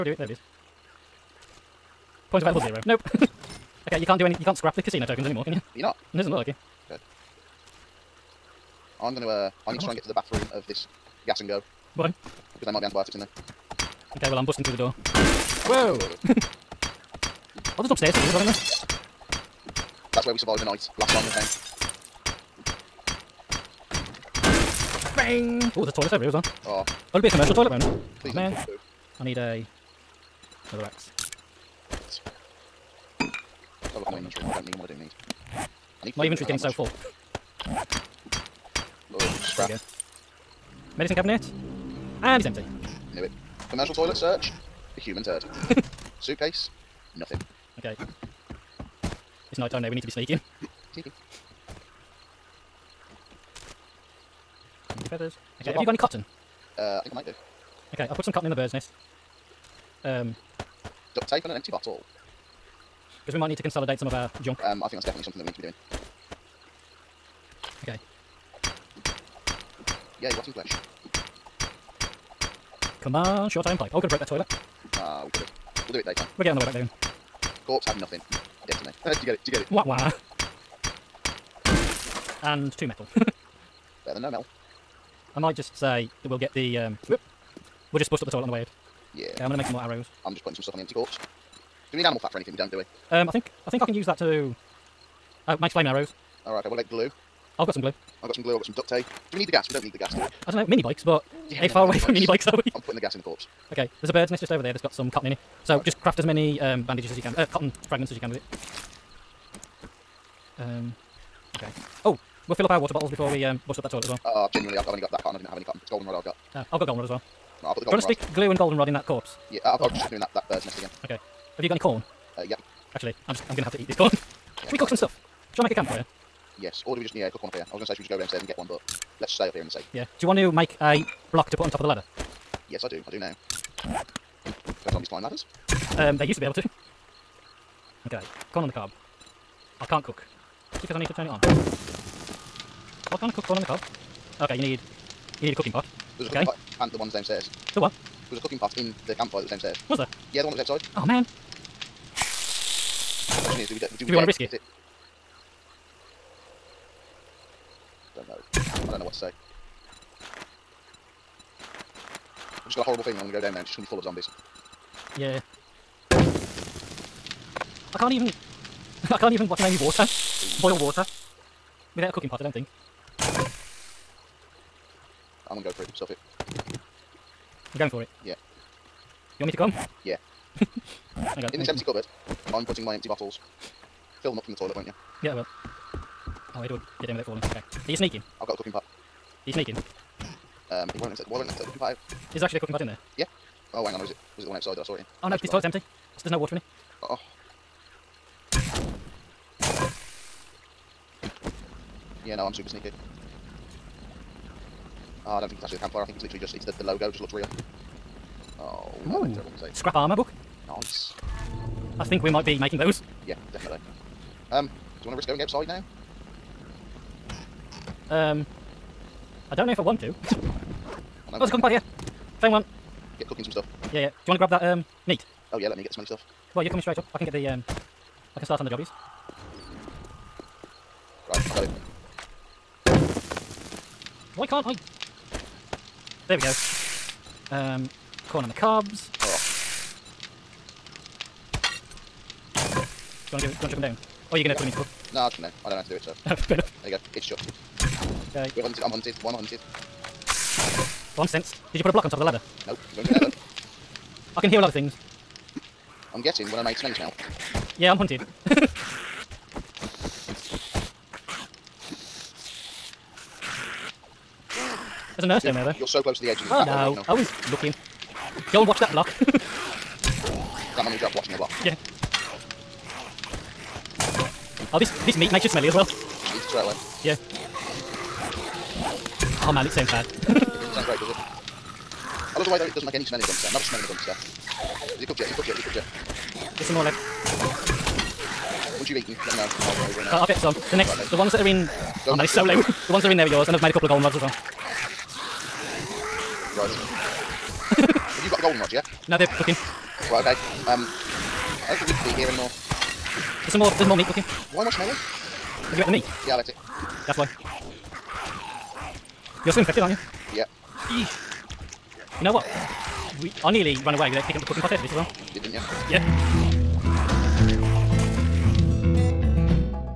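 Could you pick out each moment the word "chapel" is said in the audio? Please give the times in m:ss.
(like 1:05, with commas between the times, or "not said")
not said.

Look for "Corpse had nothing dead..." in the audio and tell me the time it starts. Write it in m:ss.
1:17.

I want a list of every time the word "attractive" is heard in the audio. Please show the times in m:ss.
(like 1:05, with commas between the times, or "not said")
not said.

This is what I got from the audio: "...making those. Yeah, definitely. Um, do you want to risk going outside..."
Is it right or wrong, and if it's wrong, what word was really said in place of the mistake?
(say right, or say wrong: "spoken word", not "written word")
right.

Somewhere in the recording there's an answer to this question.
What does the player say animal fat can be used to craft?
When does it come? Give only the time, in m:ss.
1:35.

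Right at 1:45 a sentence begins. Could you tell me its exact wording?
So just craft as many um, bandages as you can, uh, cotton fragments as you can with it.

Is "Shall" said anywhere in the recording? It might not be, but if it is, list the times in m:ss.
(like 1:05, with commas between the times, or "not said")
2:05.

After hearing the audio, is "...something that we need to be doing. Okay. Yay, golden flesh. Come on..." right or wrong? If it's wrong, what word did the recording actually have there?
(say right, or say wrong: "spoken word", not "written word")
wrong: "rotten", not "golden".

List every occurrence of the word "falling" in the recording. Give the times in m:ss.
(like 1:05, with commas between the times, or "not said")
3:07.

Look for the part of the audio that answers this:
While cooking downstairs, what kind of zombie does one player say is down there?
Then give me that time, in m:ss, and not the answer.
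4:25.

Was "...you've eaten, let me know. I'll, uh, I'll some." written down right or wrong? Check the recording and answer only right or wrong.
right.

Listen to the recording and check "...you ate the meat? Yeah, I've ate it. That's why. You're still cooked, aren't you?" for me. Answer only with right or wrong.
wrong.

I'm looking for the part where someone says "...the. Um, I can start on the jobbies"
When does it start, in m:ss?
3:47.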